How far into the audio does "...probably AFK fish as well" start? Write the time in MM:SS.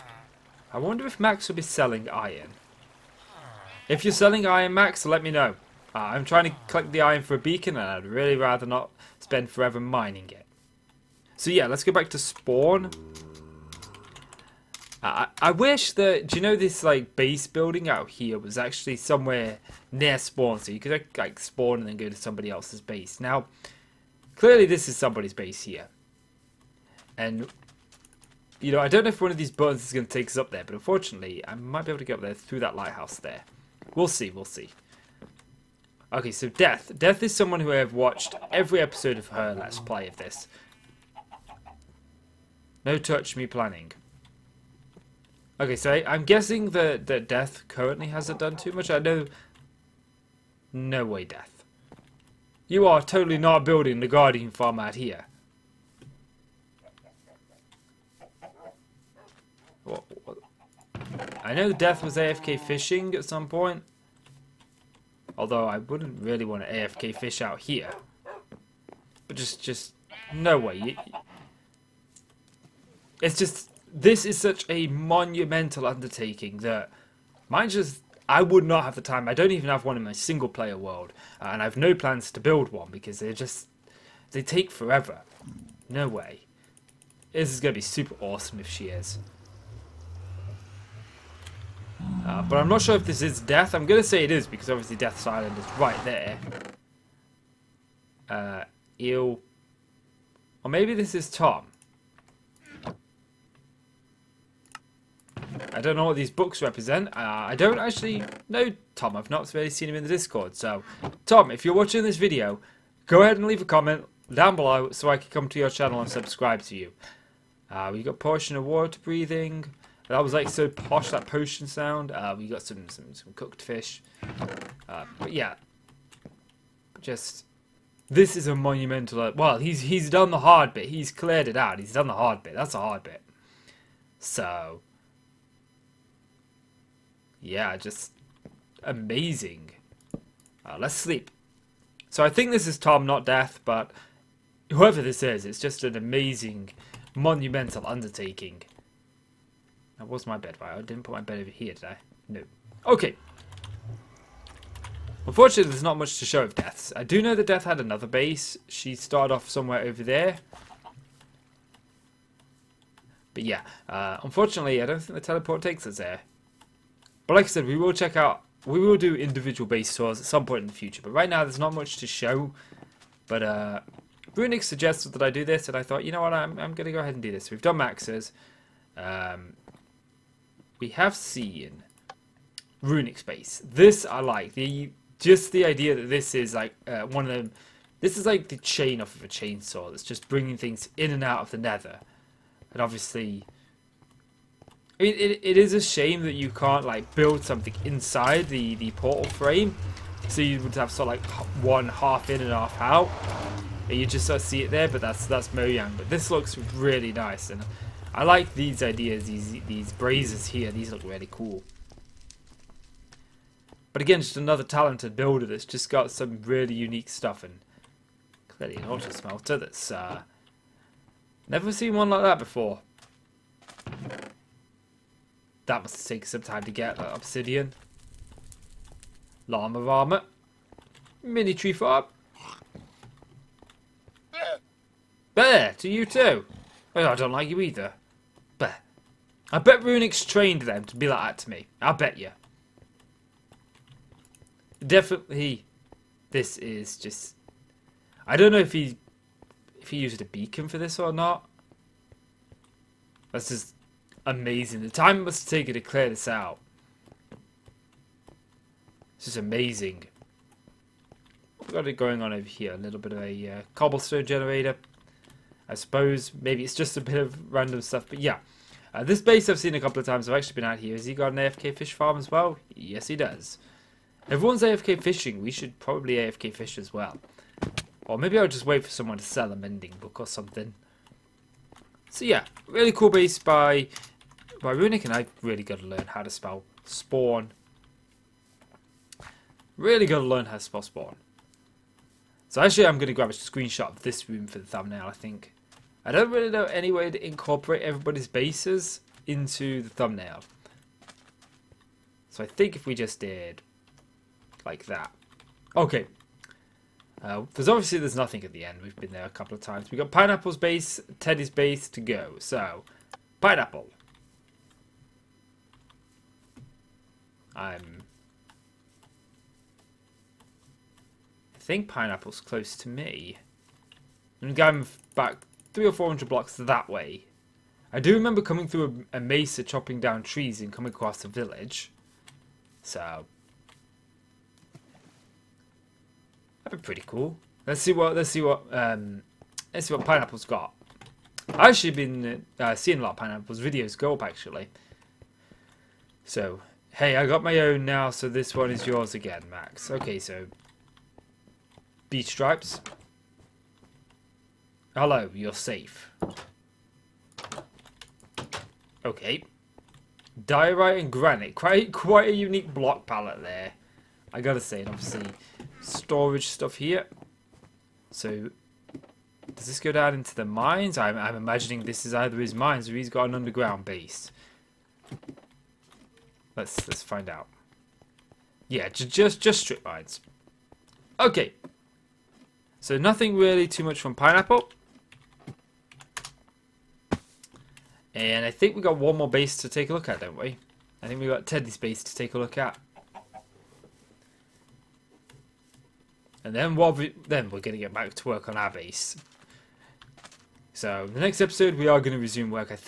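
04:35.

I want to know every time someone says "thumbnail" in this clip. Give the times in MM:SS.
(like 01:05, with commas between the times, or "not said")
04:54, 04:59.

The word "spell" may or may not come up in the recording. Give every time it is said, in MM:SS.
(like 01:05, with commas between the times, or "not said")
04:46, 04:50.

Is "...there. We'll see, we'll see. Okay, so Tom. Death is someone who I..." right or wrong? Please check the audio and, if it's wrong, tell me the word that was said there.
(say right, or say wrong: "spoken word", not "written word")
wrong: "Death", not "Tom".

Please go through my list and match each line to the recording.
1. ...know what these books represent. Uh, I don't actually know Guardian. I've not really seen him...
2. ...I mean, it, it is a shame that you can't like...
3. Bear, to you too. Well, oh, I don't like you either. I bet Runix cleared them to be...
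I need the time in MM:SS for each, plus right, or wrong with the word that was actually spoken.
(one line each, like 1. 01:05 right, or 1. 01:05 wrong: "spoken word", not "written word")
1. 01:45 wrong: "Tom", not "Guardian"
2. 03:14 right
3. 03:55 wrong: "trained", not "cleared".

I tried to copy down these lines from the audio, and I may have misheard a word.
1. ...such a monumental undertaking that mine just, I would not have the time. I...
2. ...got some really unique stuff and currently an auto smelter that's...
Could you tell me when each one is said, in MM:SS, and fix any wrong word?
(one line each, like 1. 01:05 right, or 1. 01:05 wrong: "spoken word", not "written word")
1. 01:14 right
2. 03:35 wrong: "clearly", not "currently".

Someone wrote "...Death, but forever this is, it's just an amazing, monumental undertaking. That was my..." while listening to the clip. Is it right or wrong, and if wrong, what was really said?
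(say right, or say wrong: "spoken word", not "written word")
wrong: "whoever", not "forever".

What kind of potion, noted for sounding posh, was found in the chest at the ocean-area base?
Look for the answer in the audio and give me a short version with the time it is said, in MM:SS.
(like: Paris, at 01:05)
Water breathing, at 01:58.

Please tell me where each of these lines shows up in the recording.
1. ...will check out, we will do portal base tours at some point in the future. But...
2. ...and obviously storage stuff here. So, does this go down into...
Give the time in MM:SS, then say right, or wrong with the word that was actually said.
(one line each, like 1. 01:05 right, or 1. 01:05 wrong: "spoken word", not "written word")
1. 02:47 wrong: "individual", not "portal"
2. 06:04 right.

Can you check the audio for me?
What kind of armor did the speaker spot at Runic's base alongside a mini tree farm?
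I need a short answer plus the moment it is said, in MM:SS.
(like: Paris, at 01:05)
Llama armor, at 03:49.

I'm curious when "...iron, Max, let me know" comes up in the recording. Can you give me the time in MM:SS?
00:04.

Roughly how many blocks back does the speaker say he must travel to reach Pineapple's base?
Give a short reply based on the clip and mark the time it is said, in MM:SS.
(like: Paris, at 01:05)
300 or 400, at 05:25.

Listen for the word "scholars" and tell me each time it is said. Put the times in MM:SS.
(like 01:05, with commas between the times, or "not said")
not said.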